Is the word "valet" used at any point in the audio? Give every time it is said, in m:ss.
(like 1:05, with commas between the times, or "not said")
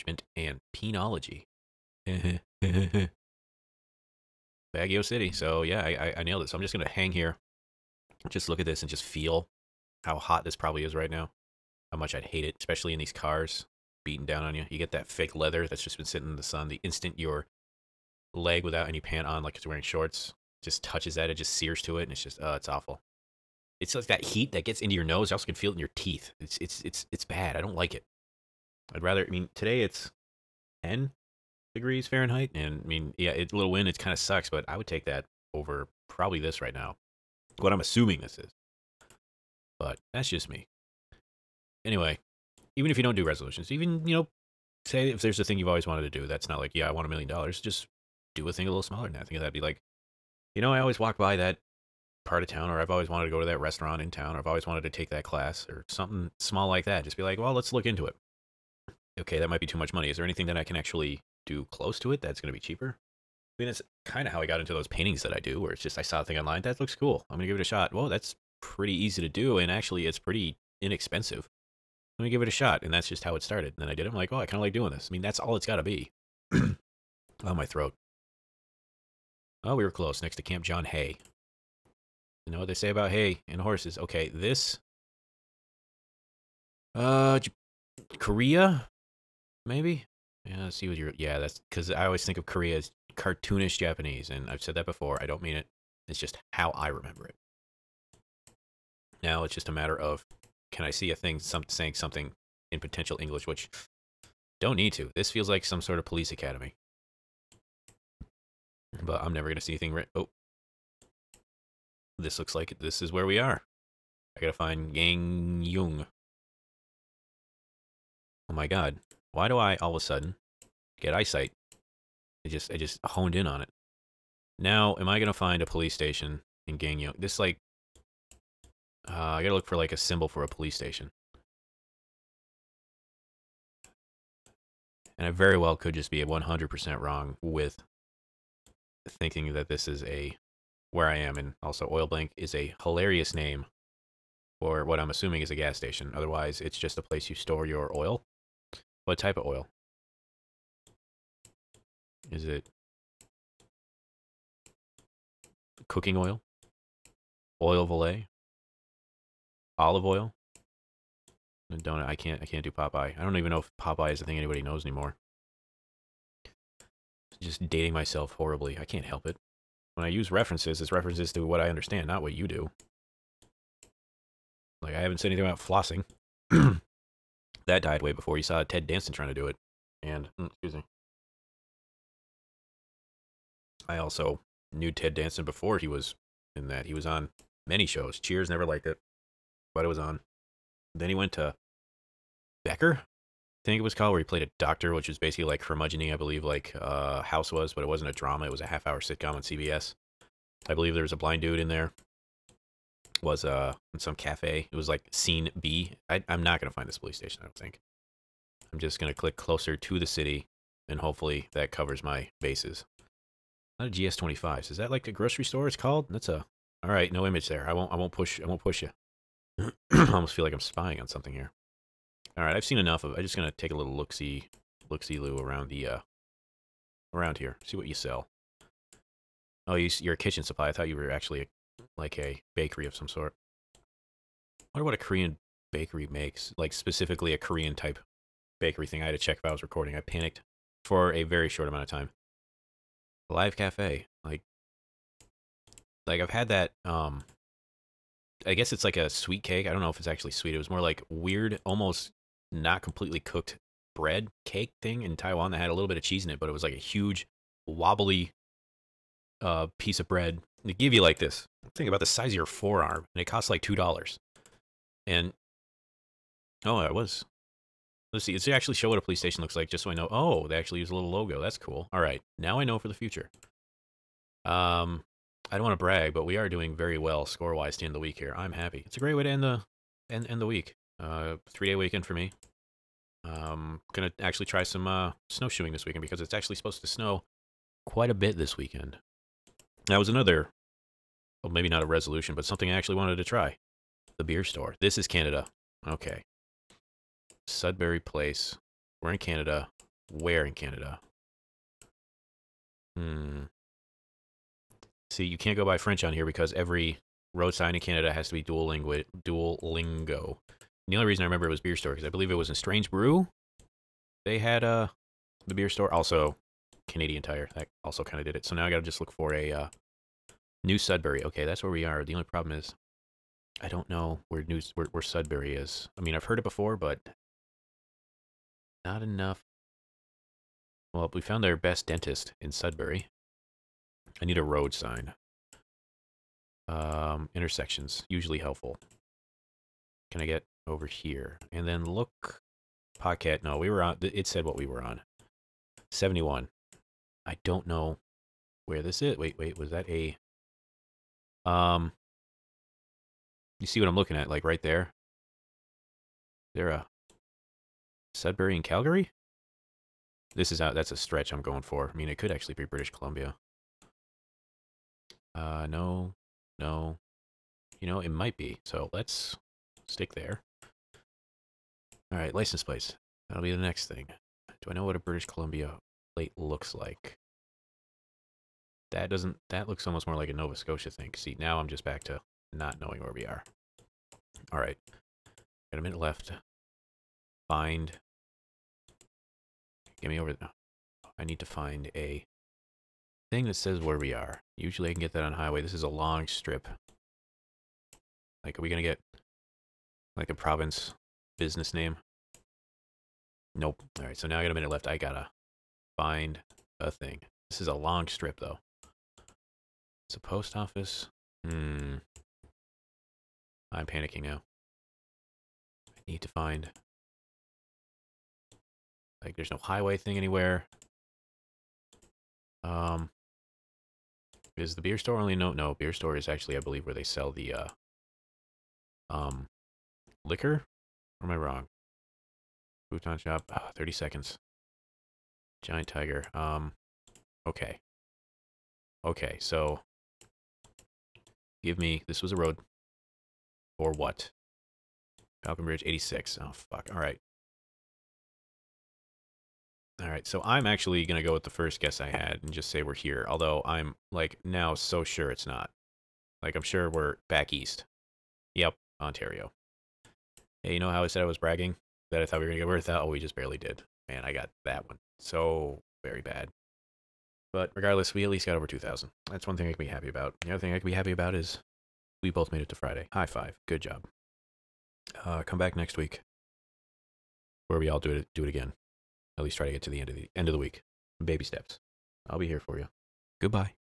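2:37.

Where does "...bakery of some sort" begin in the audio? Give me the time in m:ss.
3:52.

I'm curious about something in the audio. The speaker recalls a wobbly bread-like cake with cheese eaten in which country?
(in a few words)
Taiwan.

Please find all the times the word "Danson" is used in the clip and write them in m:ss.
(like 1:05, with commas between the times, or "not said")
2:58, 3:05.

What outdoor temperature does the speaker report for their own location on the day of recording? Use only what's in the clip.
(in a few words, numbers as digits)
10 degrees Fahrenheit.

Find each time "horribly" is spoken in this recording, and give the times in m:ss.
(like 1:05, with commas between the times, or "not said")
2:48.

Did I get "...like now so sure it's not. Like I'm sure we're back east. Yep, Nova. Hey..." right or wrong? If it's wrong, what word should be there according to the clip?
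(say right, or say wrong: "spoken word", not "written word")
wrong: "Ontario", not "Nova".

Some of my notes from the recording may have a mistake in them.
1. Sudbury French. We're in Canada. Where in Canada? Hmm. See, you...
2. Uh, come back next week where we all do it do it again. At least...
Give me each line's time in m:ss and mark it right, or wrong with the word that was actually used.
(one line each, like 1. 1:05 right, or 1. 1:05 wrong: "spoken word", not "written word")
1. 4:57 wrong: "Place", not "French"
2. 7:55 right.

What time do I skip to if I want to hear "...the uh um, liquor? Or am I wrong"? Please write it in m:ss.
7:07.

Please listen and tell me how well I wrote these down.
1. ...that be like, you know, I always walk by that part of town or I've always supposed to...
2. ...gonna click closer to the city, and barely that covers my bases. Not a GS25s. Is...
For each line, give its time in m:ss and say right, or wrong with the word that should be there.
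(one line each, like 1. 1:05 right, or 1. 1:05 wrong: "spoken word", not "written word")
1. 0:49 wrong: "wanted", not "supposed"
2. 3:28 wrong: "hopefully", not "barely".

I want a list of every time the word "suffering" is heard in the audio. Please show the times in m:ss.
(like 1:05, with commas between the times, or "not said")
not said.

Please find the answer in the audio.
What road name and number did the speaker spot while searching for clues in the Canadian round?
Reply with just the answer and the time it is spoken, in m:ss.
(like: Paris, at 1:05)
Falconbridge 86, at 7:25.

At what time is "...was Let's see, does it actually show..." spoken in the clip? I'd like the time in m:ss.
4:26.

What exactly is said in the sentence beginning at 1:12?
And that's just how it started.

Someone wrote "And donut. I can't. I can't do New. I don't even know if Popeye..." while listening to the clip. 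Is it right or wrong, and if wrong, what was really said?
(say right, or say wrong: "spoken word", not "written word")
wrong: "Popeye", not "New".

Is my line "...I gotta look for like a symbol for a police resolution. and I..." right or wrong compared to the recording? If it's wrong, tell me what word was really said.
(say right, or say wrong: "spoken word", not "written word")
wrong: "station", not "resolution".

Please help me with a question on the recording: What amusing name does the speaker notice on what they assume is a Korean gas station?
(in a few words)
Oil blank.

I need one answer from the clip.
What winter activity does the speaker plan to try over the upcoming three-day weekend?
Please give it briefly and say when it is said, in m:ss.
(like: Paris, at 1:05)
Snowshoeing, at 4:45.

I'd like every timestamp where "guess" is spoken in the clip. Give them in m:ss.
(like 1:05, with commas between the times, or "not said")
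4:08, 7:31.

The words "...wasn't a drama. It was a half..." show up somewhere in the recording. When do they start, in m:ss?
3:17.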